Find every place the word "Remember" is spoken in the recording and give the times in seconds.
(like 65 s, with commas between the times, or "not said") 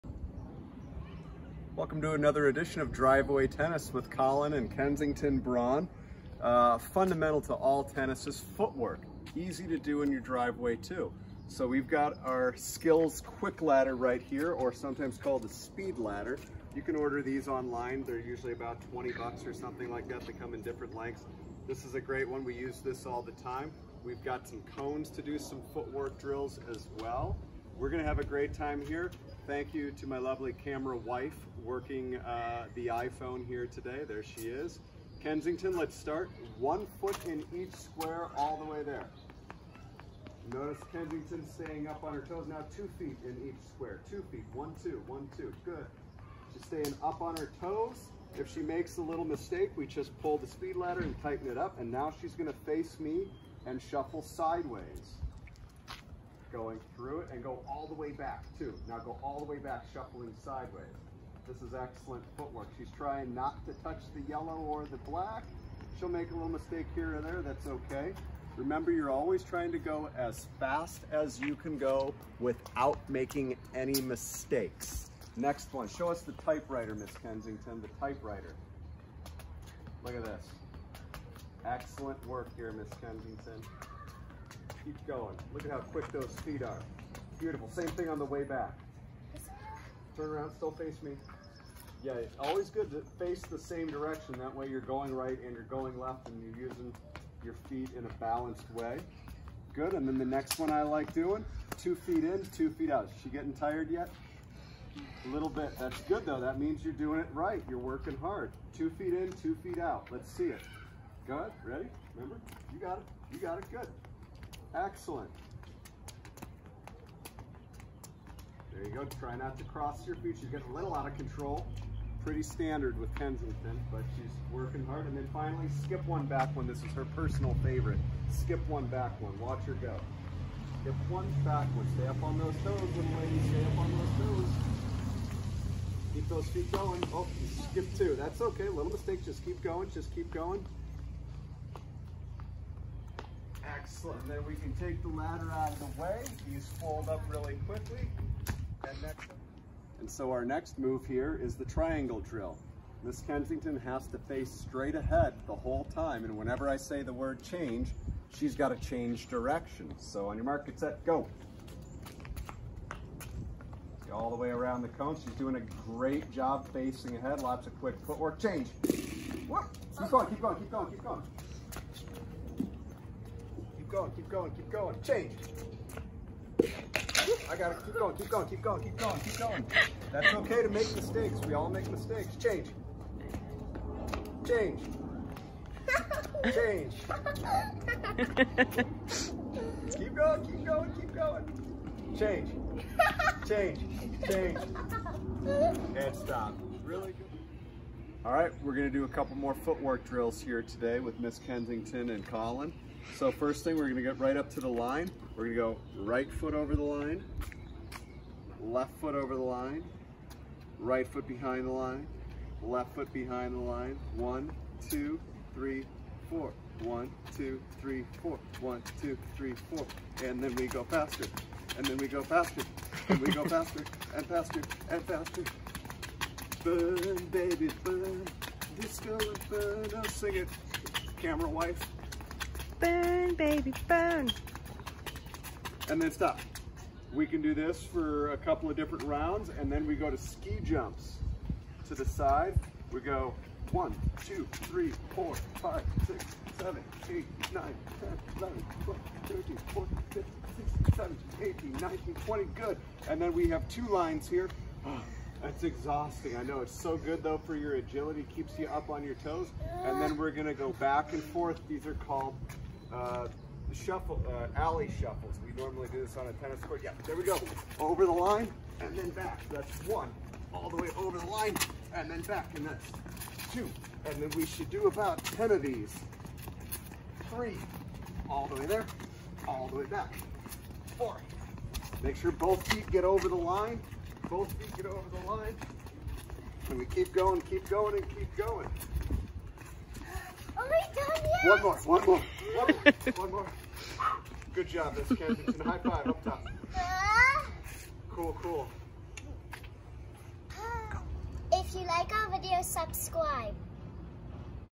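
68 s, 112 s.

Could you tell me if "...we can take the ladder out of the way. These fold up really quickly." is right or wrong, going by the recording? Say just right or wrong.
right.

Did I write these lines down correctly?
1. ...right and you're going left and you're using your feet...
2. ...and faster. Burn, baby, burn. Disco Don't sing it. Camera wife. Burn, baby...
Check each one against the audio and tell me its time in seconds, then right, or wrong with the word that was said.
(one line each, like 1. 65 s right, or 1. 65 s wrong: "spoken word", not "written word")
1. 95 s right
2. 224 s right.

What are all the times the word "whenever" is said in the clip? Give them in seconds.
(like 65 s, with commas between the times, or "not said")
156 s.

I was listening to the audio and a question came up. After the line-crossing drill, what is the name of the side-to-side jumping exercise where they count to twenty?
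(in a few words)
Ski jumps.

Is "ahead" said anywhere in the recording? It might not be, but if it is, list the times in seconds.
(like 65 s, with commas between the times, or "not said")
154 s, 167 s.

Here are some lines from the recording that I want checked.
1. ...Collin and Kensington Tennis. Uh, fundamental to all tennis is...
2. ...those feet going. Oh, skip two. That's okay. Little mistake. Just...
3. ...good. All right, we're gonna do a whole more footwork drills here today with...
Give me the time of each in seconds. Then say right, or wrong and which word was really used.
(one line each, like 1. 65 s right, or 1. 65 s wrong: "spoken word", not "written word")
1. 4 s wrong: "Braun", not "Tennis"
2. 136 s right
3. 197 s wrong: "couple", not "whole".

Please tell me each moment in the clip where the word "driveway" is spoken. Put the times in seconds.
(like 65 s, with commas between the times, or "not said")
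2 s, 10 s.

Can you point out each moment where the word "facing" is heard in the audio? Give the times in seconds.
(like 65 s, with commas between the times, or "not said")
166 s.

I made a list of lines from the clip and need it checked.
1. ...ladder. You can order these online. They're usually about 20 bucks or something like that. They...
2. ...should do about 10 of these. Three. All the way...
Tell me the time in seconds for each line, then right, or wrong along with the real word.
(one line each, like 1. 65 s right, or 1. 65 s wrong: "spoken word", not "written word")
1. 15 s right
2. 274 s right.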